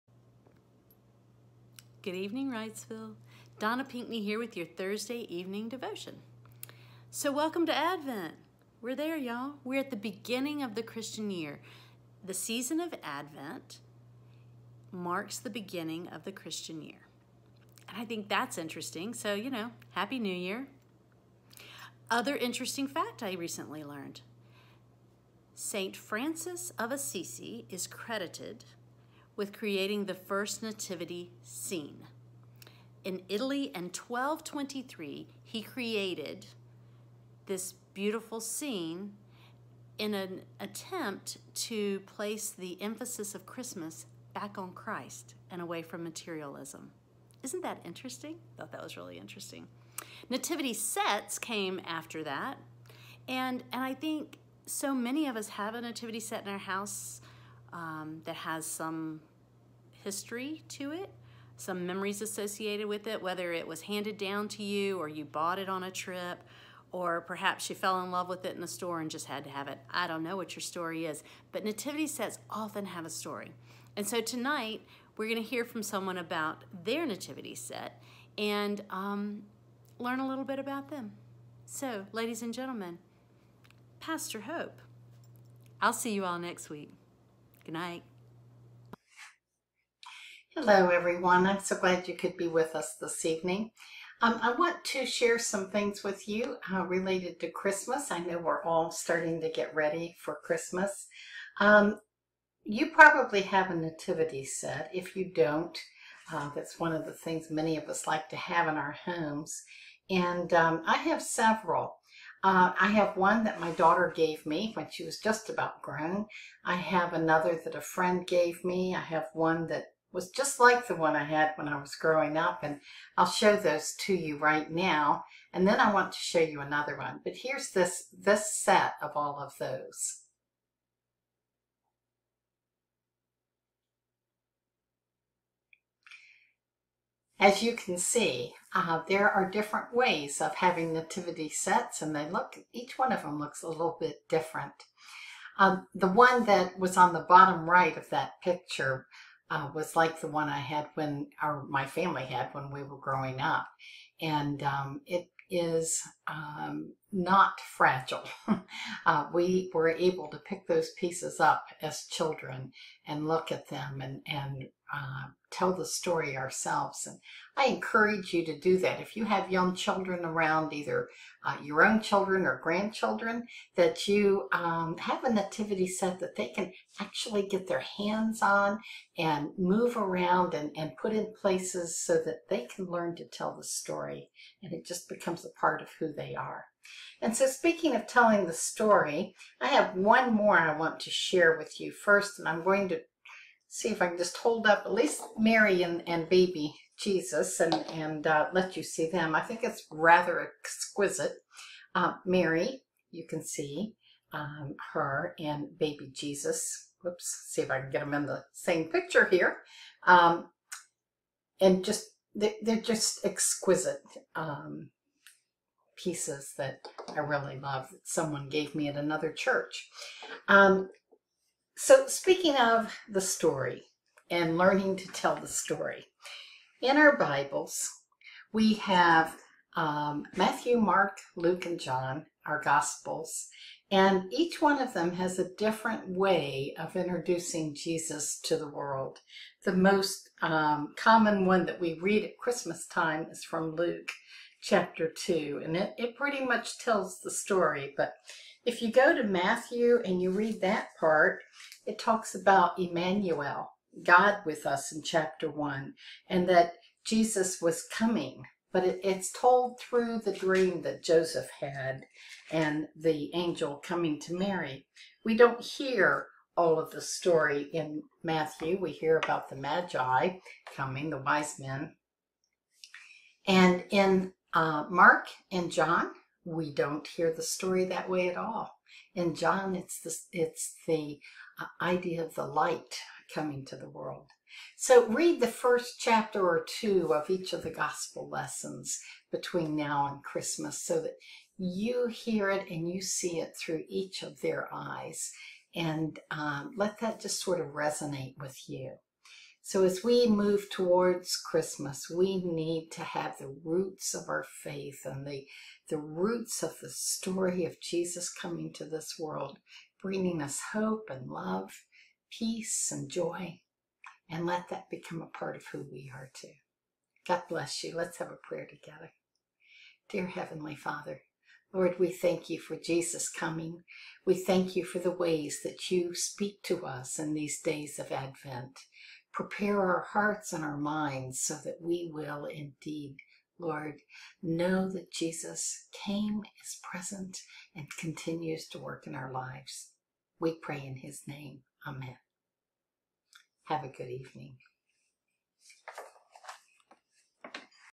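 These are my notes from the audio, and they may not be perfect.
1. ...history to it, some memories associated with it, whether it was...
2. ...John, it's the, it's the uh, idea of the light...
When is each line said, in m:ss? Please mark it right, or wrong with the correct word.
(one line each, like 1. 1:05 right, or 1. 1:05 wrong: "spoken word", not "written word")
1. 1:00 right
2. 4:39 right.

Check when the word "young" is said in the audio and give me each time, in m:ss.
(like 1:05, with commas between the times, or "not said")
2:49.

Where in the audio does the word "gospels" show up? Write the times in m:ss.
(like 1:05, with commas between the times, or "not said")
3:52, 4:47.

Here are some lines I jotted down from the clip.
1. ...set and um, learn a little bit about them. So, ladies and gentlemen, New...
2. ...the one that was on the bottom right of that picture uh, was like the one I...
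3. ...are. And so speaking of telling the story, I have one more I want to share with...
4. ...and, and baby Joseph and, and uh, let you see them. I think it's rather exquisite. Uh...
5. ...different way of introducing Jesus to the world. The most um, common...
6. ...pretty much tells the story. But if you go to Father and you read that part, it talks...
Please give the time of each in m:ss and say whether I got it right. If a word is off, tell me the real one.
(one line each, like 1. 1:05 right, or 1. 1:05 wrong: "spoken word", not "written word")
1. 1:17 wrong: "Pastor", not "New"
2. 2:25 right
3. 3:06 right
4. 3:15 wrong: "Jesus", not "Joseph"
5. 3:55 right
6. 4:06 wrong: "Matthew", not "Father".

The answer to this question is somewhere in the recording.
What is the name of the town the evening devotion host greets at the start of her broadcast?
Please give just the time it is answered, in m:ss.
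0:02.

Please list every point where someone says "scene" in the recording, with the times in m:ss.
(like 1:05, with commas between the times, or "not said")
0:31, 0:38.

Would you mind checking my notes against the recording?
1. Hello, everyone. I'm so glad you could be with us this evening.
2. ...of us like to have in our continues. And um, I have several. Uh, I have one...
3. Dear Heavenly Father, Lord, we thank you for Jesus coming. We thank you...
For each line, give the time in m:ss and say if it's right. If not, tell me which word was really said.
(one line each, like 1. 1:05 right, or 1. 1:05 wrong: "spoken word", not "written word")
1. 1:30 right
2. 1:47 wrong: "homes", not "continues"
3. 5:20 right.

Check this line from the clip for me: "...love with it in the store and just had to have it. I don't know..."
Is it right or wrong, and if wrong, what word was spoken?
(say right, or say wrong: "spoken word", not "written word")
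right.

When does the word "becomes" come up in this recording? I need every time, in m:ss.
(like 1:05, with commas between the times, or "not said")
3:05, 5:14.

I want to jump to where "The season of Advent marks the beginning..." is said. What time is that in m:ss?
0:12.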